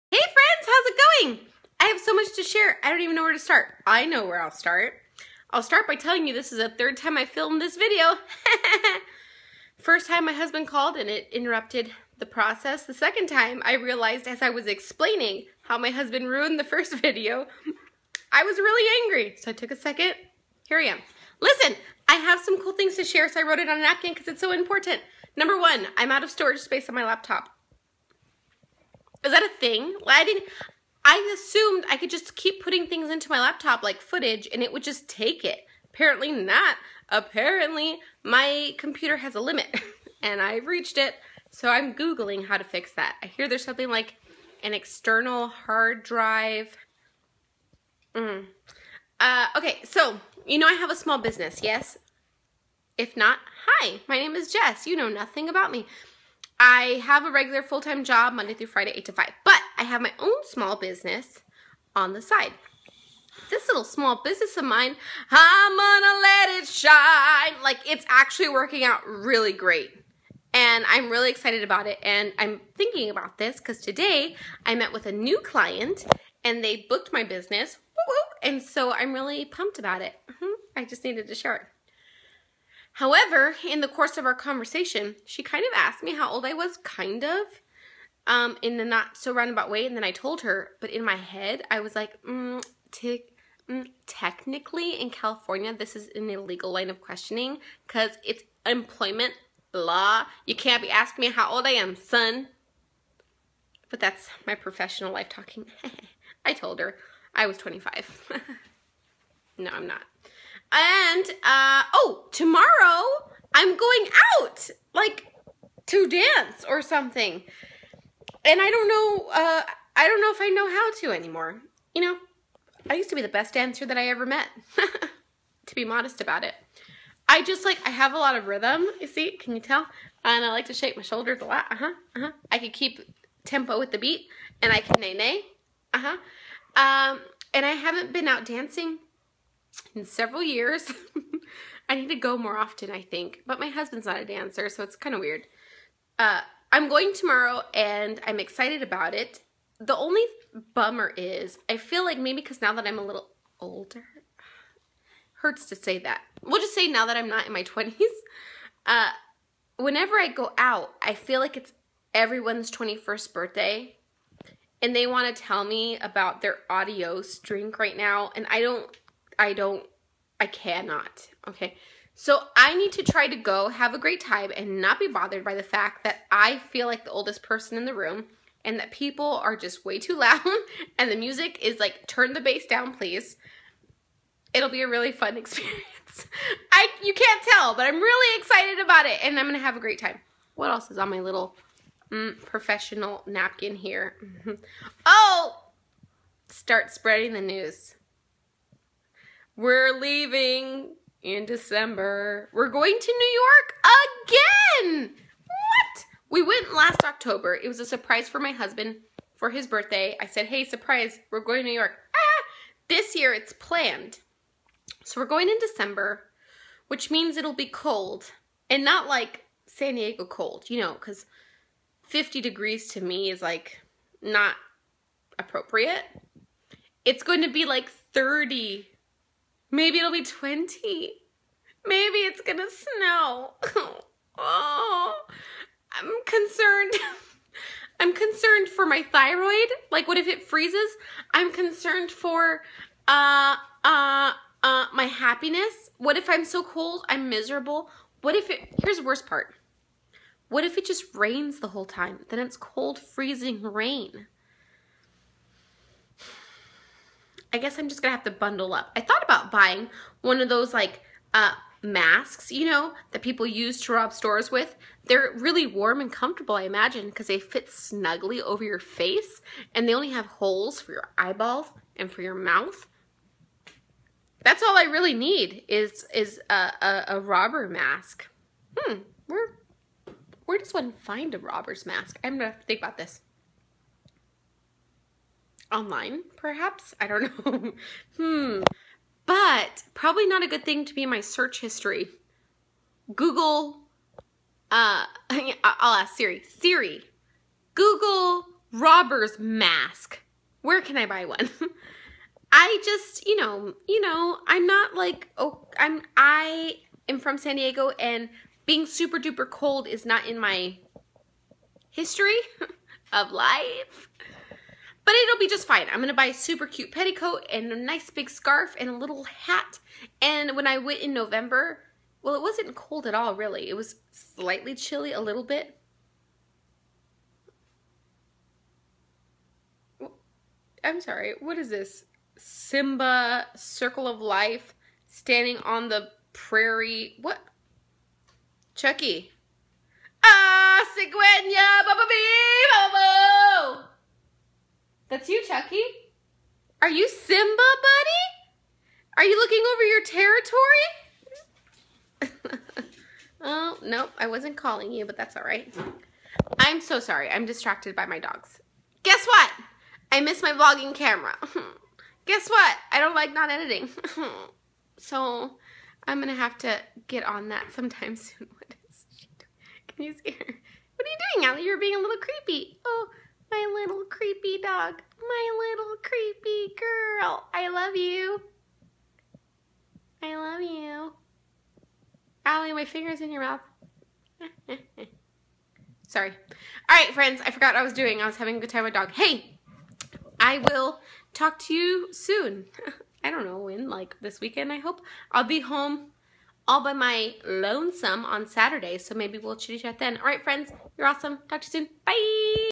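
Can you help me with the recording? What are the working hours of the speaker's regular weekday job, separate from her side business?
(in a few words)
8 to 5.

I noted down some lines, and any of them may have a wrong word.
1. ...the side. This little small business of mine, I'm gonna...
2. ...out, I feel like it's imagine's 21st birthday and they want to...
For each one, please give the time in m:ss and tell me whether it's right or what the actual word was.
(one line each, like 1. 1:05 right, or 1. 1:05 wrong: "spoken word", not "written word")
1. 1:02 right
2. 2:40 wrong: "everyone", not "imagine".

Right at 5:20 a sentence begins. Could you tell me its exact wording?
And when I went in November, well, it wasn't cold at all, really.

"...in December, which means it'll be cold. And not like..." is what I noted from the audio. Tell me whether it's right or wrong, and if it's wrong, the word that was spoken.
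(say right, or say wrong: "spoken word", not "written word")
right.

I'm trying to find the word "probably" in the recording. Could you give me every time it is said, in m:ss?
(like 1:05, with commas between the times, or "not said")
4:49.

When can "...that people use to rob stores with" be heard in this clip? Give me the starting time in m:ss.
4:23.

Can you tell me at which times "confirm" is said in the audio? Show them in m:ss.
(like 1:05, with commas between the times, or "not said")
not said.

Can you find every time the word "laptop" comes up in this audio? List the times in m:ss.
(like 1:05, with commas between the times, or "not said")
0:27, 0:33.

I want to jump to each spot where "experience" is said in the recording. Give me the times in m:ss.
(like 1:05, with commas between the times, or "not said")
3:05.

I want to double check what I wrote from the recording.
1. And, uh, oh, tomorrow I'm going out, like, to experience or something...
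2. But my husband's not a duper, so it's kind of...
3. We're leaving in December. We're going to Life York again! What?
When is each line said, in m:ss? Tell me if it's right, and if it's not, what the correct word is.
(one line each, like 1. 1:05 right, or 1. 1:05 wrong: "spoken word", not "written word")
1. 1:50 wrong: "dance", not "experience"
2. 2:23 wrong: "dancer", not "duper"
3. 3:19 wrong: "New", not "Life".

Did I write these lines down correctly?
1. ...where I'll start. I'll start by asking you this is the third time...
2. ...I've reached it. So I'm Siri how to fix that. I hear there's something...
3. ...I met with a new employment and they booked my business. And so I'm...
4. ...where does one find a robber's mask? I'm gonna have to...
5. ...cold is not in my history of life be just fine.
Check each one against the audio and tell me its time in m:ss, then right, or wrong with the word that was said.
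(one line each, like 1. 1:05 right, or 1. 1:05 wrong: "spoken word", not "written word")
1. 0:04 wrong: "telling", not "asking"
2. 0:40 wrong: "Googling", not "Siri"
3. 1:14 wrong: "client", not "employment"
4. 4:40 right
5. 5:09 right.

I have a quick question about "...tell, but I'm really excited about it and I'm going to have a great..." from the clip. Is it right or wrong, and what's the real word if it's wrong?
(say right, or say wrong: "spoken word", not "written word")
right.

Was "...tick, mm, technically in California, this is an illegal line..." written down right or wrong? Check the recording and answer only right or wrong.
right.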